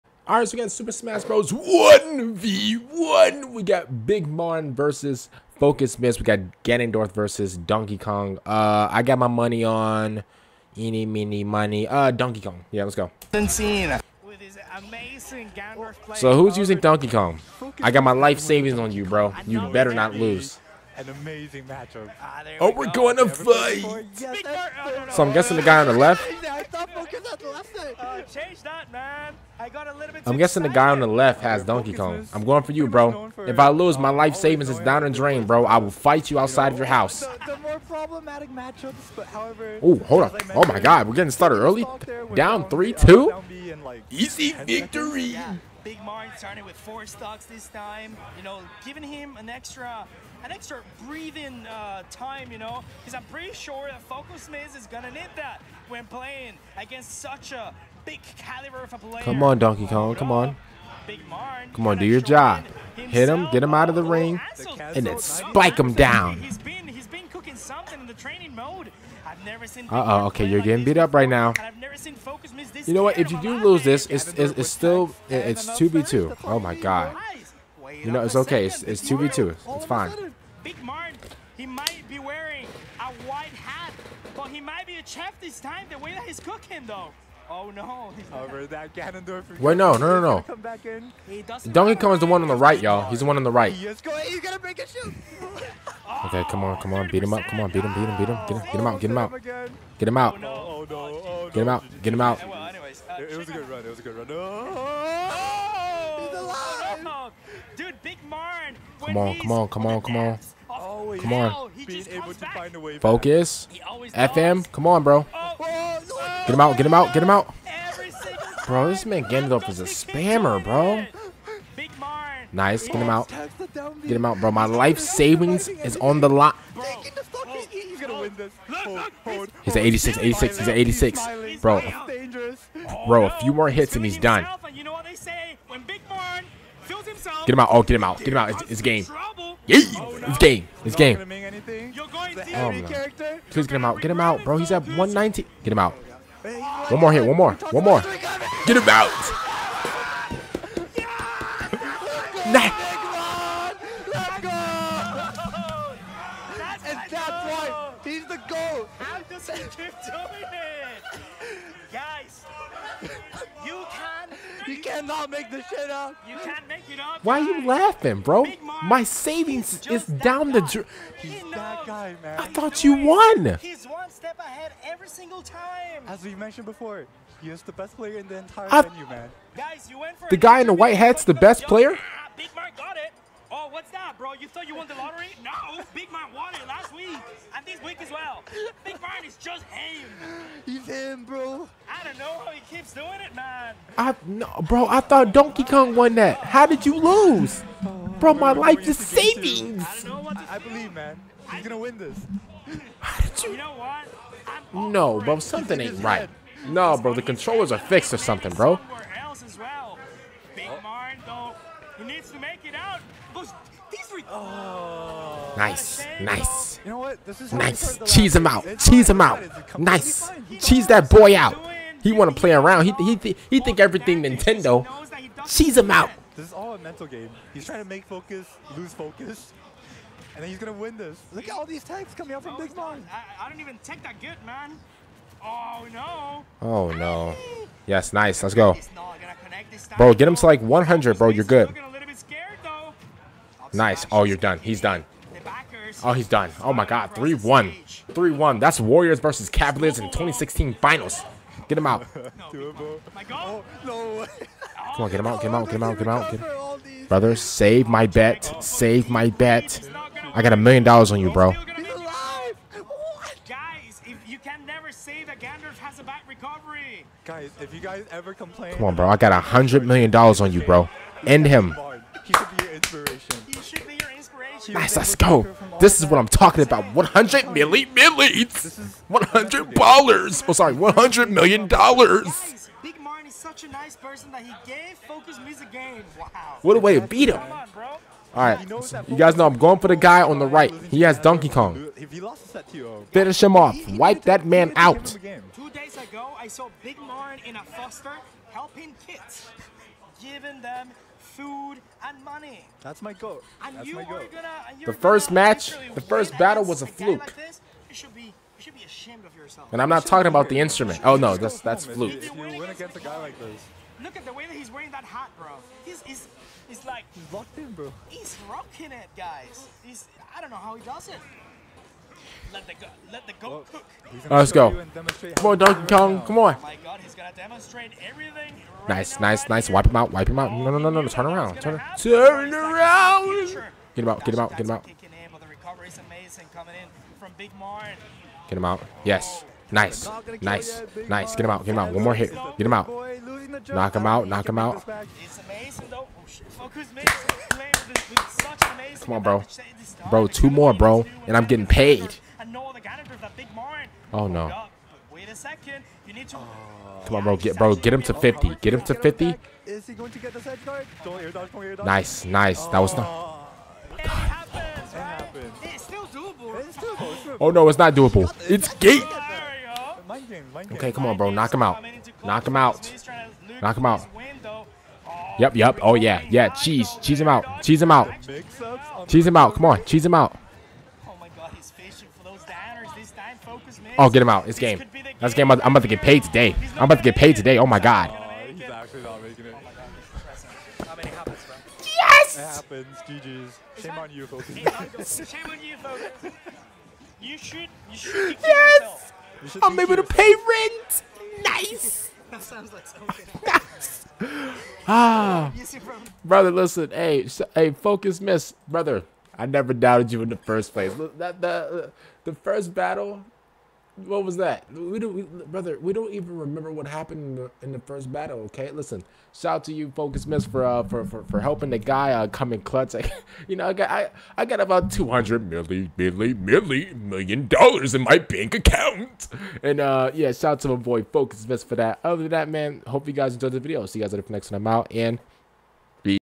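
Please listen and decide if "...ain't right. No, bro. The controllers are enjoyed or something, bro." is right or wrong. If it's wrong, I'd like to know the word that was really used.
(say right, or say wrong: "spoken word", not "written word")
wrong: "fixed", not "enjoyed".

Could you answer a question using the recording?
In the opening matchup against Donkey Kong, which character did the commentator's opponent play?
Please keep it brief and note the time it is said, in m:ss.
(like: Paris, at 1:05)
Ganondorf, at 0:06.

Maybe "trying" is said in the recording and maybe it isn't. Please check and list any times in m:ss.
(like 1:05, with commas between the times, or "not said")
3:47.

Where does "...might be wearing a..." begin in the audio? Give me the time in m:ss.
1:21.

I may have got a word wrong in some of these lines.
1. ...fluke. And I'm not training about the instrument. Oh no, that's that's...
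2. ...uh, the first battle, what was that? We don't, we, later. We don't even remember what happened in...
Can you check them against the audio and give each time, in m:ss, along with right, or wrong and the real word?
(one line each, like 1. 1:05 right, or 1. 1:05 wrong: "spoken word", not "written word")
1. 5:06 wrong: "talking", not "training"
2. 6:51 wrong: "brother", not "later".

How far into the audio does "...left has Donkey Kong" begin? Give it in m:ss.
0:31.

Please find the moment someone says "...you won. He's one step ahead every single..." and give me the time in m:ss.
2:52.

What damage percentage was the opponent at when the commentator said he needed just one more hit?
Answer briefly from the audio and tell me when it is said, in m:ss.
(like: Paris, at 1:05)
190, at 2:24.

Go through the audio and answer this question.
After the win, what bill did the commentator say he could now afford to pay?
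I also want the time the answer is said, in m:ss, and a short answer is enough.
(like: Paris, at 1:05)
rent, at 6:40.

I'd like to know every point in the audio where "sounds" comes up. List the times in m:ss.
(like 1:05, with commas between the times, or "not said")
6:42.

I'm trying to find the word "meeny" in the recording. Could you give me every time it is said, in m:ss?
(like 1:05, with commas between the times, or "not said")
0:11.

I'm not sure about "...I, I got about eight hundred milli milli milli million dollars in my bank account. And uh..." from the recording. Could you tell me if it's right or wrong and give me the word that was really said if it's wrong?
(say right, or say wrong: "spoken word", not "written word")
wrong: "two", not "eight".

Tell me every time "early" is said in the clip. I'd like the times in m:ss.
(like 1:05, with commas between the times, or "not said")
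0:41.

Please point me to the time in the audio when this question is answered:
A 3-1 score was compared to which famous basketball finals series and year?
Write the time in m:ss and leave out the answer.
4:10.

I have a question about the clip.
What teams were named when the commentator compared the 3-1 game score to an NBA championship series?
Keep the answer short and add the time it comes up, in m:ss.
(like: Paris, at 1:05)
Warriors versus Cavaliers, at 4:08.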